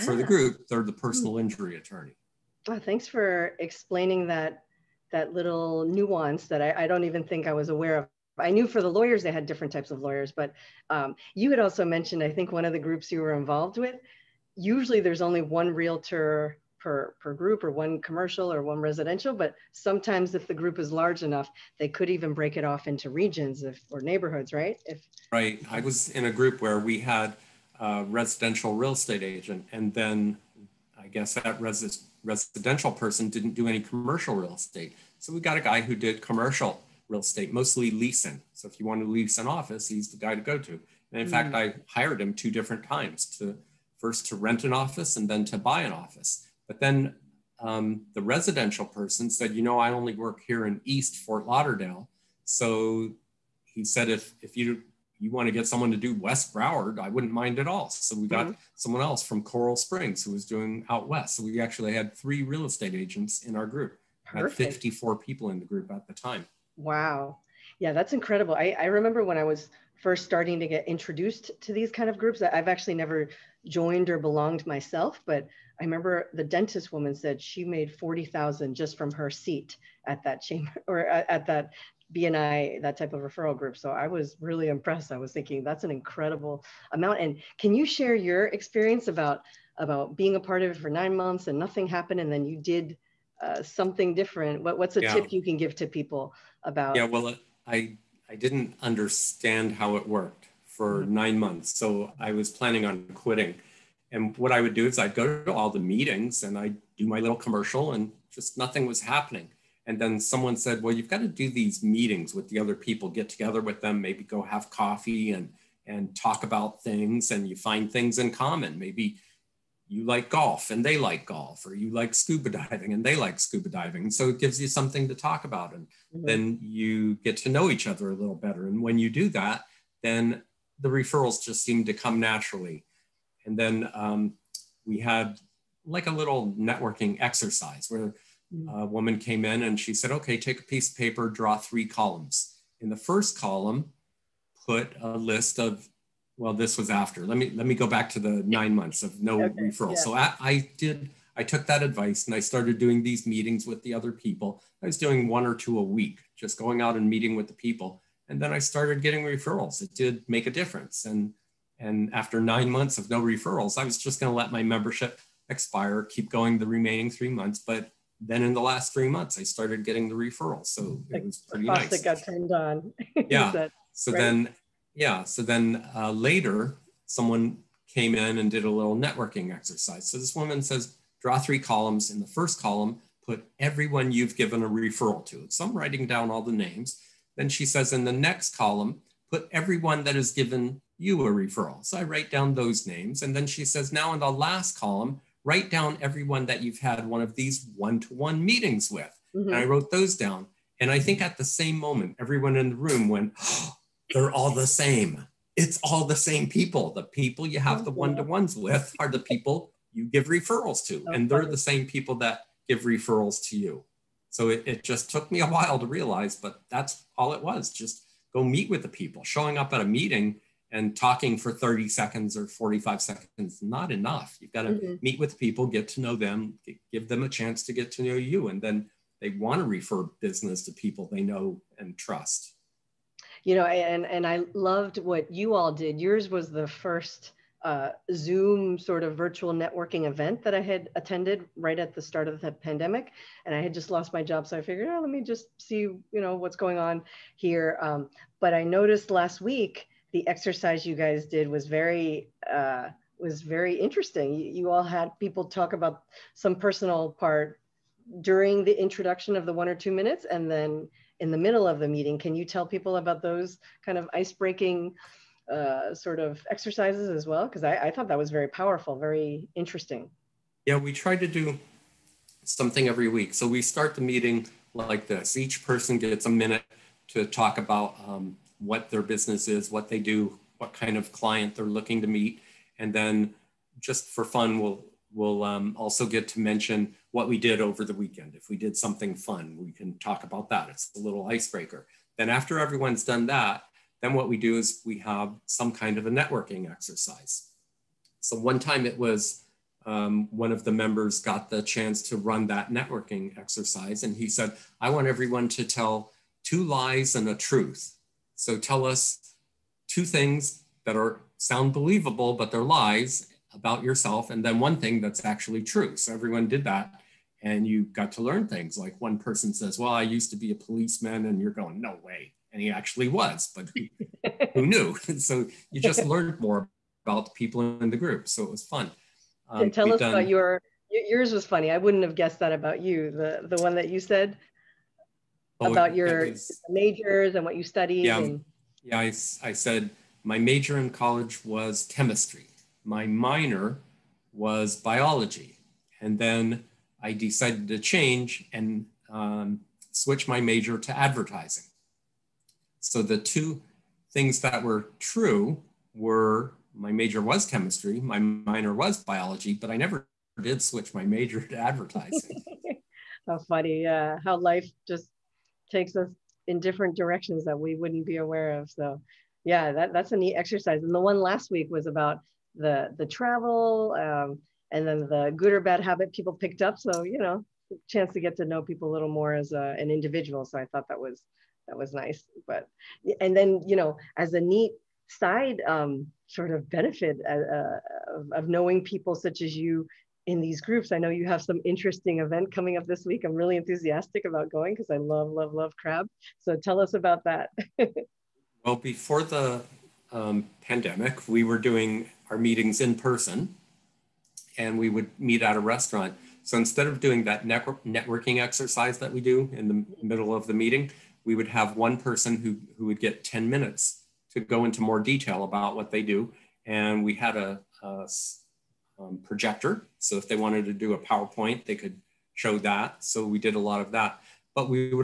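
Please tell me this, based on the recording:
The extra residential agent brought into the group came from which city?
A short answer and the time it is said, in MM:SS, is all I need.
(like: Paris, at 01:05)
Coral Springs, at 00:59.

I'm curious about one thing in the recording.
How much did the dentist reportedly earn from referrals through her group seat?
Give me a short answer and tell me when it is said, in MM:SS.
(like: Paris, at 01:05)
40,000, at 01:17.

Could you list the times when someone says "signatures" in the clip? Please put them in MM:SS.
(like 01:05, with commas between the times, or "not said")
not said.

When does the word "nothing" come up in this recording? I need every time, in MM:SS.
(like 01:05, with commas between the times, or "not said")
01:31, 01:48.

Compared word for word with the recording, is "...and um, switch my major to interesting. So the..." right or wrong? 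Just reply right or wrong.
wrong.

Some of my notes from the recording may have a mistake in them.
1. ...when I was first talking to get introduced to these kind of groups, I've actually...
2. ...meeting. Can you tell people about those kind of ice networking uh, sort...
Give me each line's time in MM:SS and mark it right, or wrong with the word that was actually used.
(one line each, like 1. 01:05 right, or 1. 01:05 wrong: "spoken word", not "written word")
1. 01:09 wrong: "starting", not "talking"
2. 04:21 wrong: "breaking", not "networking".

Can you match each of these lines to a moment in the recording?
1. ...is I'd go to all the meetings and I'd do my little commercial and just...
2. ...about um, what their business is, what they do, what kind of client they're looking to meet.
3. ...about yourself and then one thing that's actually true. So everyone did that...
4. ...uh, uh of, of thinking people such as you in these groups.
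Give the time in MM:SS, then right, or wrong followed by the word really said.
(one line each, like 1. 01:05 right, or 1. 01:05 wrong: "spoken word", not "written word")
1. 01:44 right
2. 04:37 right
3. 05:13 right
4. 06:27 wrong: "knowing", not "thinking".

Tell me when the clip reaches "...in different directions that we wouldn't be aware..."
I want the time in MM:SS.
06:06.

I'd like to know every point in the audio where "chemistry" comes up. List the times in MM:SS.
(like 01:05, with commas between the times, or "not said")
05:41, 05:57.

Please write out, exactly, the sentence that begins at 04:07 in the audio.
Um, but I noticed last week the exercise you guys did was very.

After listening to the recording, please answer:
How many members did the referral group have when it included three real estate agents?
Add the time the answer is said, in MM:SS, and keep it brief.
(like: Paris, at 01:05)
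54, at 01:04.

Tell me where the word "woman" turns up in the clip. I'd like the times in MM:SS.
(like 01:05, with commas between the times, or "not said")
01:16, 02:18, 03:00.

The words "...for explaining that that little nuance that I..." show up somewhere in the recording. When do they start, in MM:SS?
00:03.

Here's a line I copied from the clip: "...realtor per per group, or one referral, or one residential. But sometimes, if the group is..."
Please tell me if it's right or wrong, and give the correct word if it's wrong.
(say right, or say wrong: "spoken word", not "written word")
wrong: "commercial", not "referral".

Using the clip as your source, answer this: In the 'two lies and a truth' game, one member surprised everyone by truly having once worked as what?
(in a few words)
Policeman.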